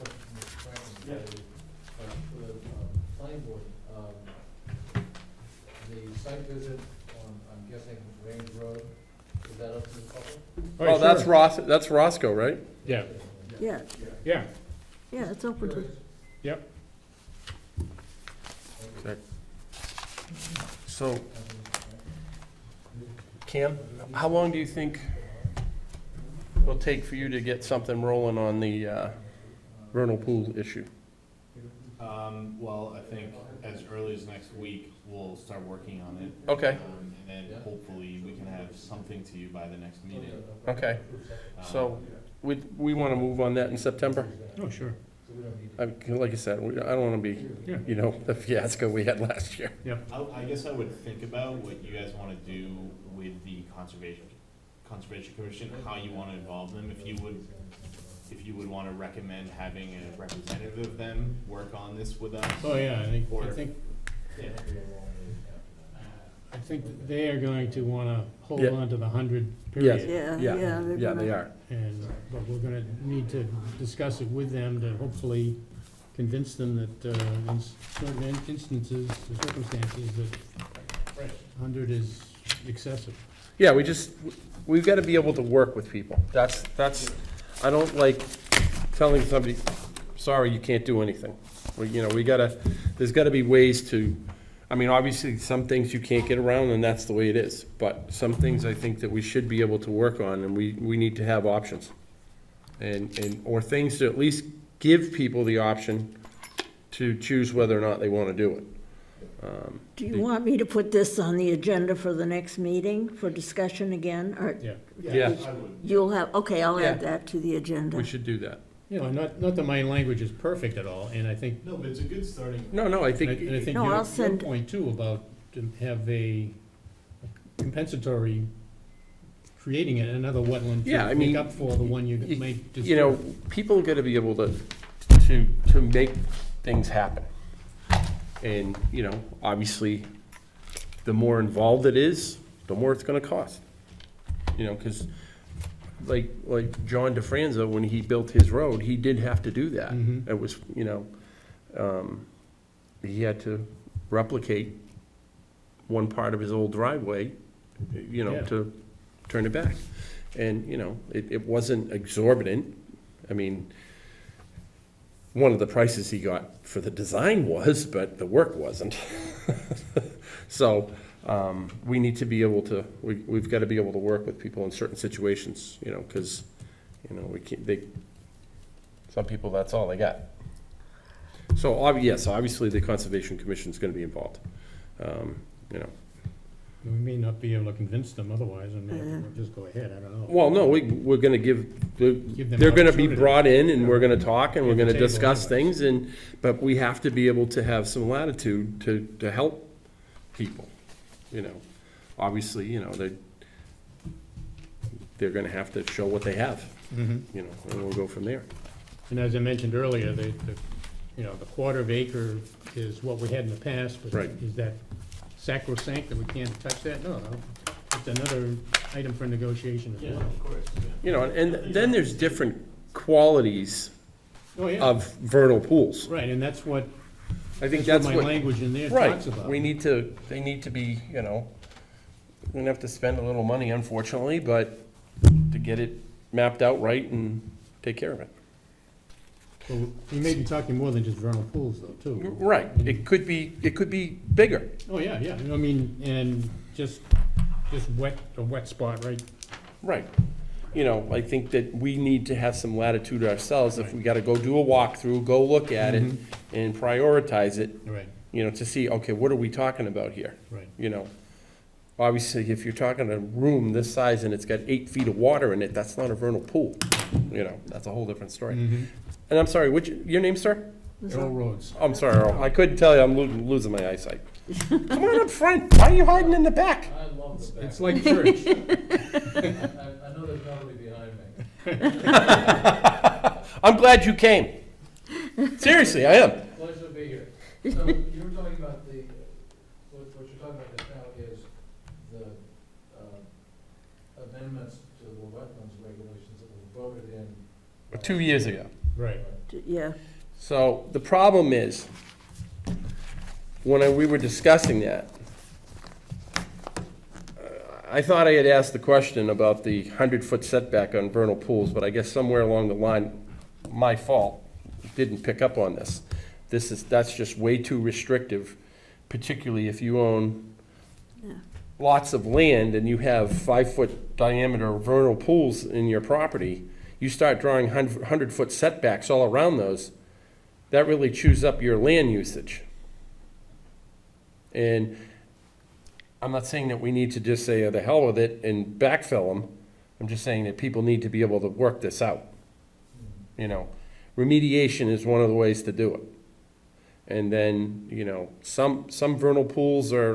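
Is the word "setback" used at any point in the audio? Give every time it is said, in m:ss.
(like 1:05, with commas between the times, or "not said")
5:10, 5:28.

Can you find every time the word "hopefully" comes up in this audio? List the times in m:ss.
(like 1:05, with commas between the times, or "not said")
0:37, 1:14.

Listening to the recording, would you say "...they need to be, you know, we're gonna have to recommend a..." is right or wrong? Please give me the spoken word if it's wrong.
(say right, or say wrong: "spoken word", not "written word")
wrong: "spend", not "recommend".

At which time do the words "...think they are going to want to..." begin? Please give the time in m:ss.
1:06.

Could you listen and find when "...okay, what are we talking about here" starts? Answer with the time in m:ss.
4:18.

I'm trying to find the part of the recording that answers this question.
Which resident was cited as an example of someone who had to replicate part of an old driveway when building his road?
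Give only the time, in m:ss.
2:26.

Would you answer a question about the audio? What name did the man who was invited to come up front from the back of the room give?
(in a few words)
Earl Rhodes.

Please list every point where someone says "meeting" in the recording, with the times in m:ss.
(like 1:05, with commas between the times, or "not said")
0:40, 1:52.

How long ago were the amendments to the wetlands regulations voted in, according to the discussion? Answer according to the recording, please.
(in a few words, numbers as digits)
2 years ago.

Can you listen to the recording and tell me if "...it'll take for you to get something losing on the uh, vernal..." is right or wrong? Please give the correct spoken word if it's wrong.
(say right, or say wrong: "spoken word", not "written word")
wrong: "rolling", not "losing".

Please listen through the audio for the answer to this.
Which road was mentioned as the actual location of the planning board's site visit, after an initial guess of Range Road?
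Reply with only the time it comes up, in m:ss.
0:11.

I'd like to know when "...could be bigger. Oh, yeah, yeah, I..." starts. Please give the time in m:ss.
4:03.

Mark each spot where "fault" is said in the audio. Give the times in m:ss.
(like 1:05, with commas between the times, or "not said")
5:13.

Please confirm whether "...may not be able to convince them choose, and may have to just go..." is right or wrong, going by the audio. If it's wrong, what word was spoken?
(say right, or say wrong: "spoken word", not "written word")
wrong: "otherwise", not "choose".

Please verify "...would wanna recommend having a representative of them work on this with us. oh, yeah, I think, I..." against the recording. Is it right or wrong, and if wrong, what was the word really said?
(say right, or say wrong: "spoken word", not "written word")
right.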